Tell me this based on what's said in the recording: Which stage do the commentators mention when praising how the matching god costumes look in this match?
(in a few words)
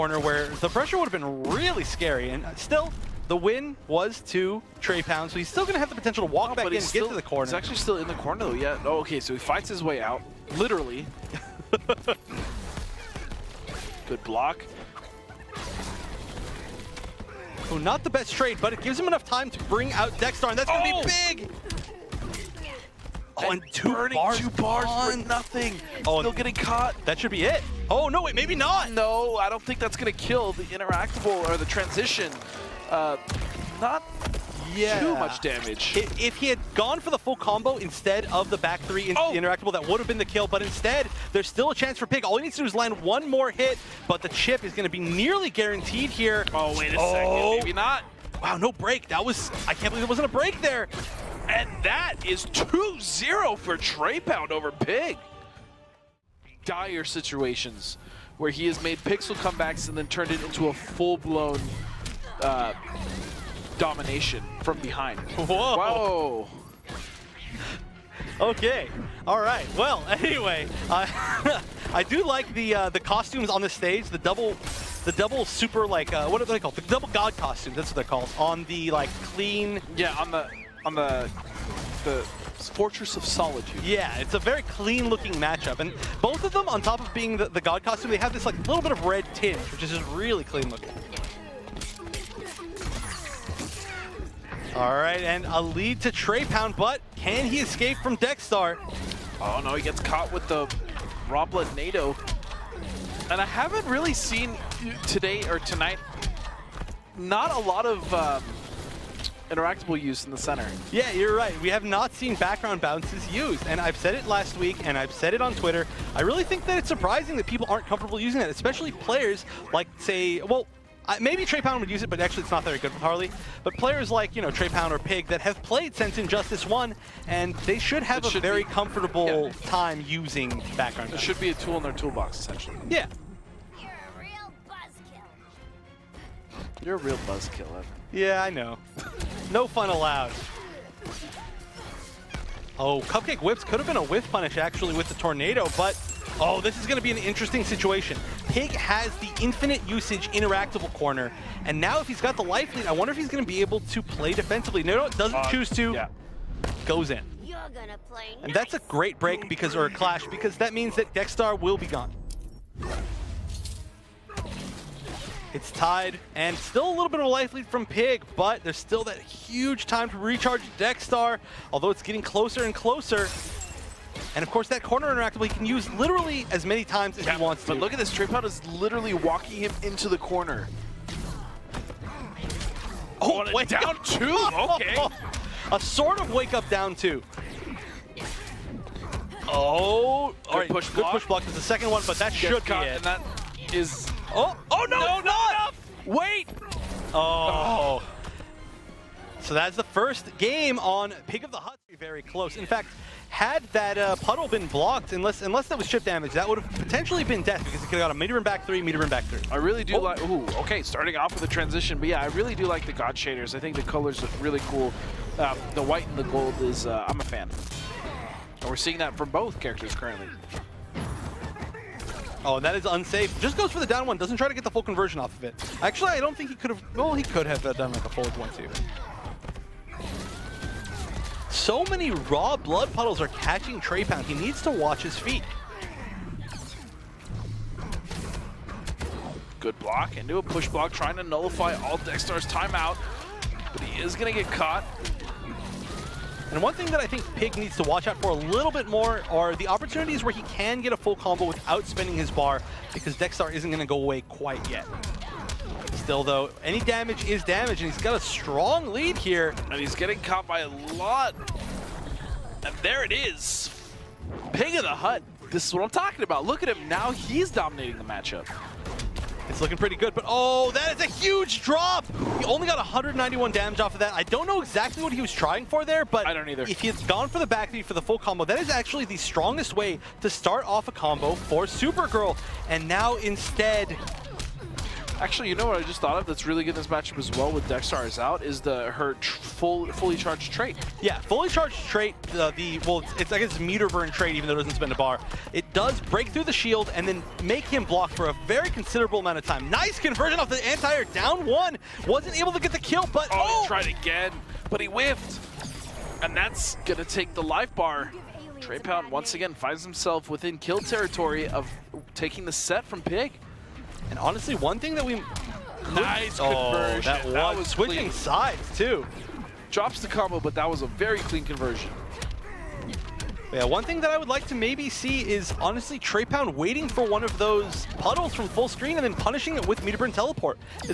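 Fortress of Solitude.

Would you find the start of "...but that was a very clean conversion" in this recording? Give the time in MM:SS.
05:20.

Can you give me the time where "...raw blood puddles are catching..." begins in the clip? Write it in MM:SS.
03:52.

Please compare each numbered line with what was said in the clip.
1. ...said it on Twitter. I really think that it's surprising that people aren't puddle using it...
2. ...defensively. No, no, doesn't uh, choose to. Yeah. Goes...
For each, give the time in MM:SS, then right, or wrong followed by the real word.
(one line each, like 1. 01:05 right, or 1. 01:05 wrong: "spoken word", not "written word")
1. 01:55 wrong: "comfortable", not "puddle"
2. 02:34 right.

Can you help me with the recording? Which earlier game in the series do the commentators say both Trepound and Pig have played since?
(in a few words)
Injustice 1.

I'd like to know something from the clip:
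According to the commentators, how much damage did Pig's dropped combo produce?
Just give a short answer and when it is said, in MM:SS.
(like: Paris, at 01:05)
191, at 04:32.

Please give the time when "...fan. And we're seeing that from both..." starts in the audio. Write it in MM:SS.
03:37.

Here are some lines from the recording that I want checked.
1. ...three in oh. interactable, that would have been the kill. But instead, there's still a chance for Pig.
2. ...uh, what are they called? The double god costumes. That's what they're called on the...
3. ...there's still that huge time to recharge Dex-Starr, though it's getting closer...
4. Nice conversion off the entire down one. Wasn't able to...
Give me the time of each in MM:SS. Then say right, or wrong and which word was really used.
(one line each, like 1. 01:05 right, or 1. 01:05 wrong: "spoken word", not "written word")
1. 00:38 right
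2. 01:16 right
3. 02:48 wrong: "although", not "though"
4. 04:59 right.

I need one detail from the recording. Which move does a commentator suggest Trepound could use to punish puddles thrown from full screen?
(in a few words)
Burn Teleport.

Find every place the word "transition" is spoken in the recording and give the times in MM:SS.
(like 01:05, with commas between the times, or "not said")
00:31, 03:31.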